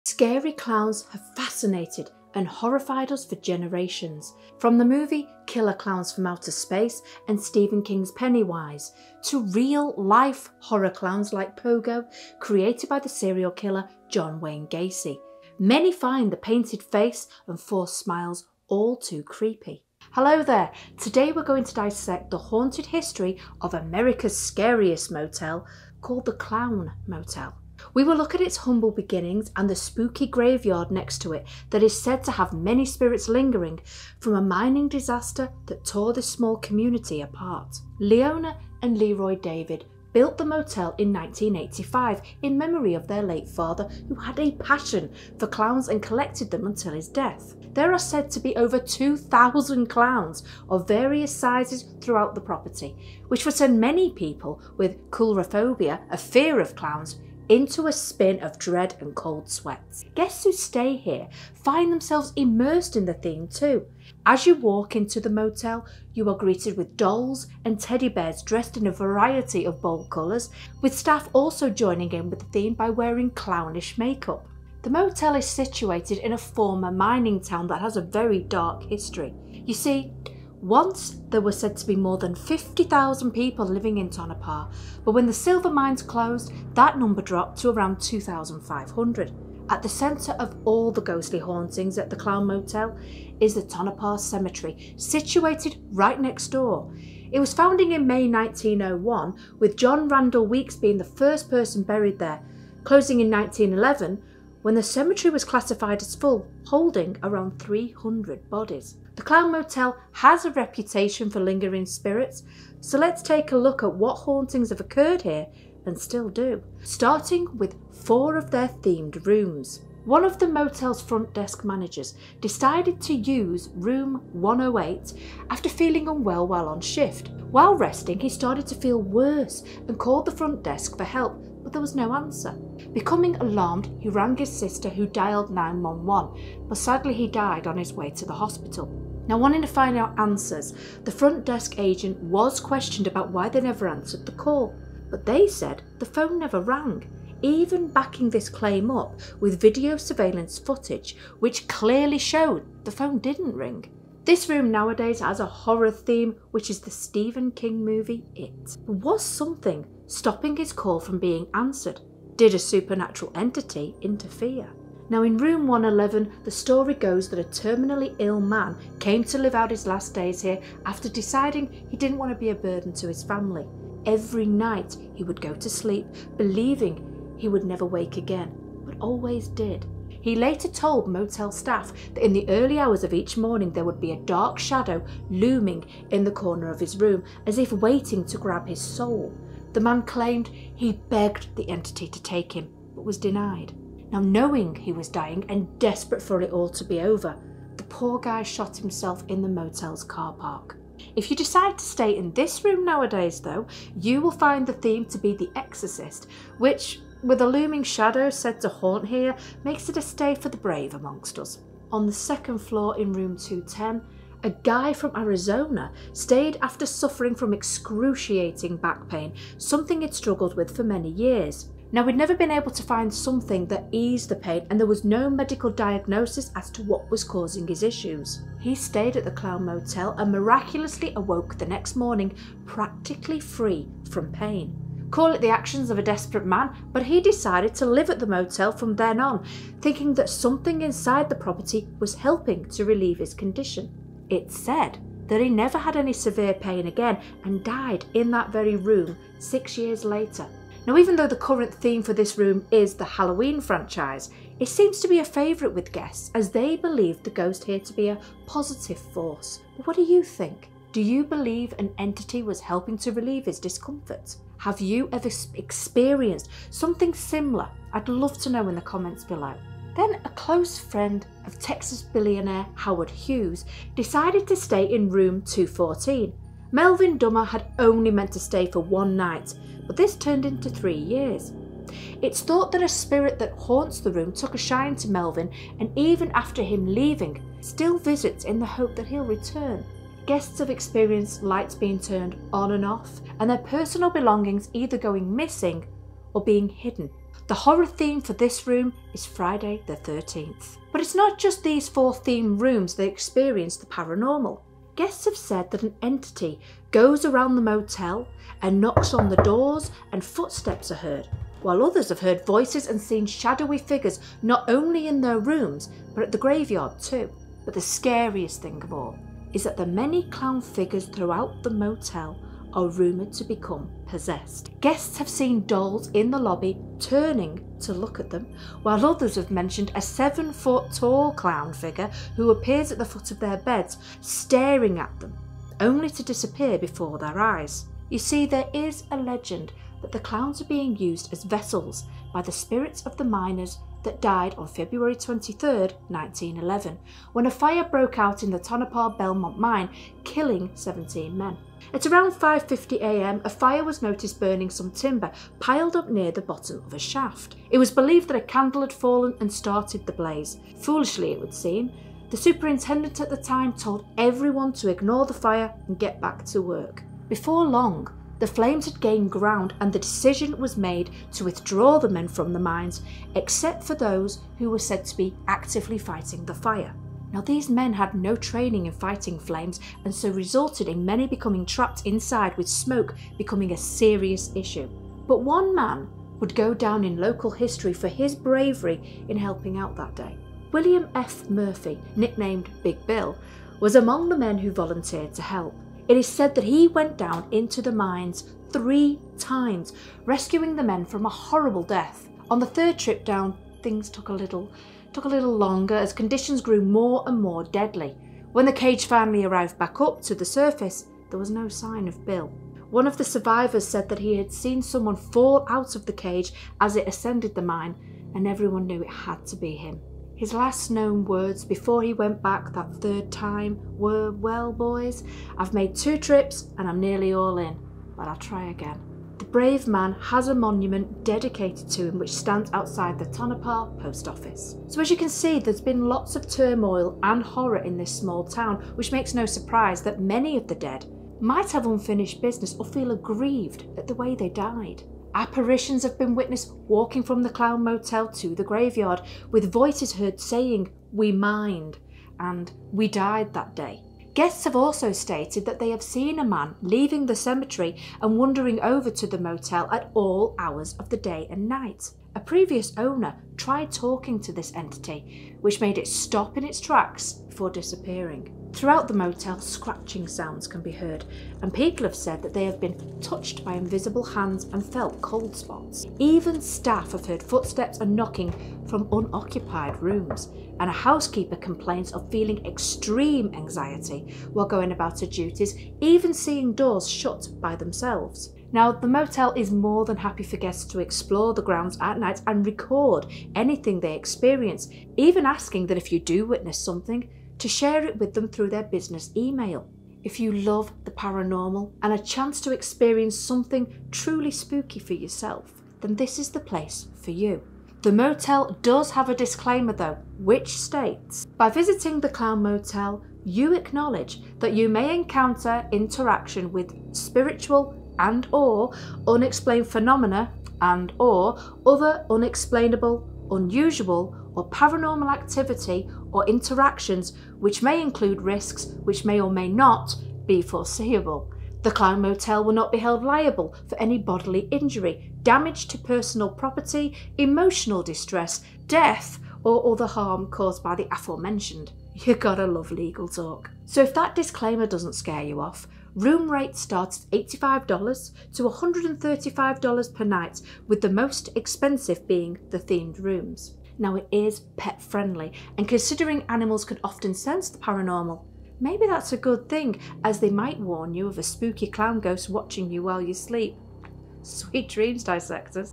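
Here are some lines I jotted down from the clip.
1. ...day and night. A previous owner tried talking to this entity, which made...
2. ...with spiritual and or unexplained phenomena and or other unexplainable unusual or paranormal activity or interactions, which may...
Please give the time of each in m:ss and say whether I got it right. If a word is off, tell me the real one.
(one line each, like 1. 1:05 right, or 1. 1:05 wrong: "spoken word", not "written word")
1. 7:41 right
2. 8:36 right.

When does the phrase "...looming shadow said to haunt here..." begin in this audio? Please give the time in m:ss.
3:27.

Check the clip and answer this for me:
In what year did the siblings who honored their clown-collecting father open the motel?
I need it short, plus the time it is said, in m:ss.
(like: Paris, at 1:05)
1985, at 0:41.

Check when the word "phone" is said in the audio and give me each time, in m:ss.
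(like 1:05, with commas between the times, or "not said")
2:26, 2:32.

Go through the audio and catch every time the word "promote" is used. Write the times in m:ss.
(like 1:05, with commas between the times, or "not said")
not said.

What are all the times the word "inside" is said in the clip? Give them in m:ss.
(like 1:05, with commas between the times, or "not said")
4:00, 6:22.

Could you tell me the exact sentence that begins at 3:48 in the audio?
He stayed at the Clown Motel and miraculously awoke the next morning practically free from pain.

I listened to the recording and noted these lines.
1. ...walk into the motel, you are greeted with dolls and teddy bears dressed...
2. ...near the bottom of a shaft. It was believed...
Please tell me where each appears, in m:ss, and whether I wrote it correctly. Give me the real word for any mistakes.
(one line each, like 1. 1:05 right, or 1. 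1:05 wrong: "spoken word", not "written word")
1. 1:04 right
2. 5:56 right.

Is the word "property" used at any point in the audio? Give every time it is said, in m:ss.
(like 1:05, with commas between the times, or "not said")
0:52, 4:01, 8:56.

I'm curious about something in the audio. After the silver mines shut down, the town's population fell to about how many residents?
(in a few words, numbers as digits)
2,500.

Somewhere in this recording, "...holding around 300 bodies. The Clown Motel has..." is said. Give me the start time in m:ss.
1:46.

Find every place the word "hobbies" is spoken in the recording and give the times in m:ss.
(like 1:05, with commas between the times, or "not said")
not said.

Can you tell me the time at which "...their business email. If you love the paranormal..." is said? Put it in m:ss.
8:18.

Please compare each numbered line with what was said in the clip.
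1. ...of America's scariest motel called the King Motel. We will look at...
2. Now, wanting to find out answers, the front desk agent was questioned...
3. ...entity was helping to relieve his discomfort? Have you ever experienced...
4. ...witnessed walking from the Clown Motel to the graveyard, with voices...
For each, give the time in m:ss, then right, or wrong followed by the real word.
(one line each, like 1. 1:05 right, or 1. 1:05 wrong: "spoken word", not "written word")
1. 0:23 wrong: "Clown", not "King"
2. 2:19 right
3. 4:21 right
4. 7:26 right.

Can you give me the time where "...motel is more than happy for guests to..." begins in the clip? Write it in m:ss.
8:09.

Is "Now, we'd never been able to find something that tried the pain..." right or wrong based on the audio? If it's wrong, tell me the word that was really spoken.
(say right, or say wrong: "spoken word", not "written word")
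wrong: "eased", not "tried".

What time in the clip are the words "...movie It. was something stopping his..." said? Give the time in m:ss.
2:37.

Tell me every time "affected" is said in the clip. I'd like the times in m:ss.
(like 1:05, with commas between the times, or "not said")
not said.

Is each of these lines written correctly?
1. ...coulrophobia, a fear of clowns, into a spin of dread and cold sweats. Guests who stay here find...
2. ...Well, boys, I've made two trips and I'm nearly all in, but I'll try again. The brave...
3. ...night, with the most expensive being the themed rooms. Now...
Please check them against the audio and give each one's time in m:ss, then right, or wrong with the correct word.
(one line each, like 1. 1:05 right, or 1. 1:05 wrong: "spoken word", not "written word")
1. 0:55 right
2. 7:04 right
3. 9:10 right.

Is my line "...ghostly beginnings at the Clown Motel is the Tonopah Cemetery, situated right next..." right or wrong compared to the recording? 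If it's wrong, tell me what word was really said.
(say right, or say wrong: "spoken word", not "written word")
wrong: "hauntings", not "beginnings".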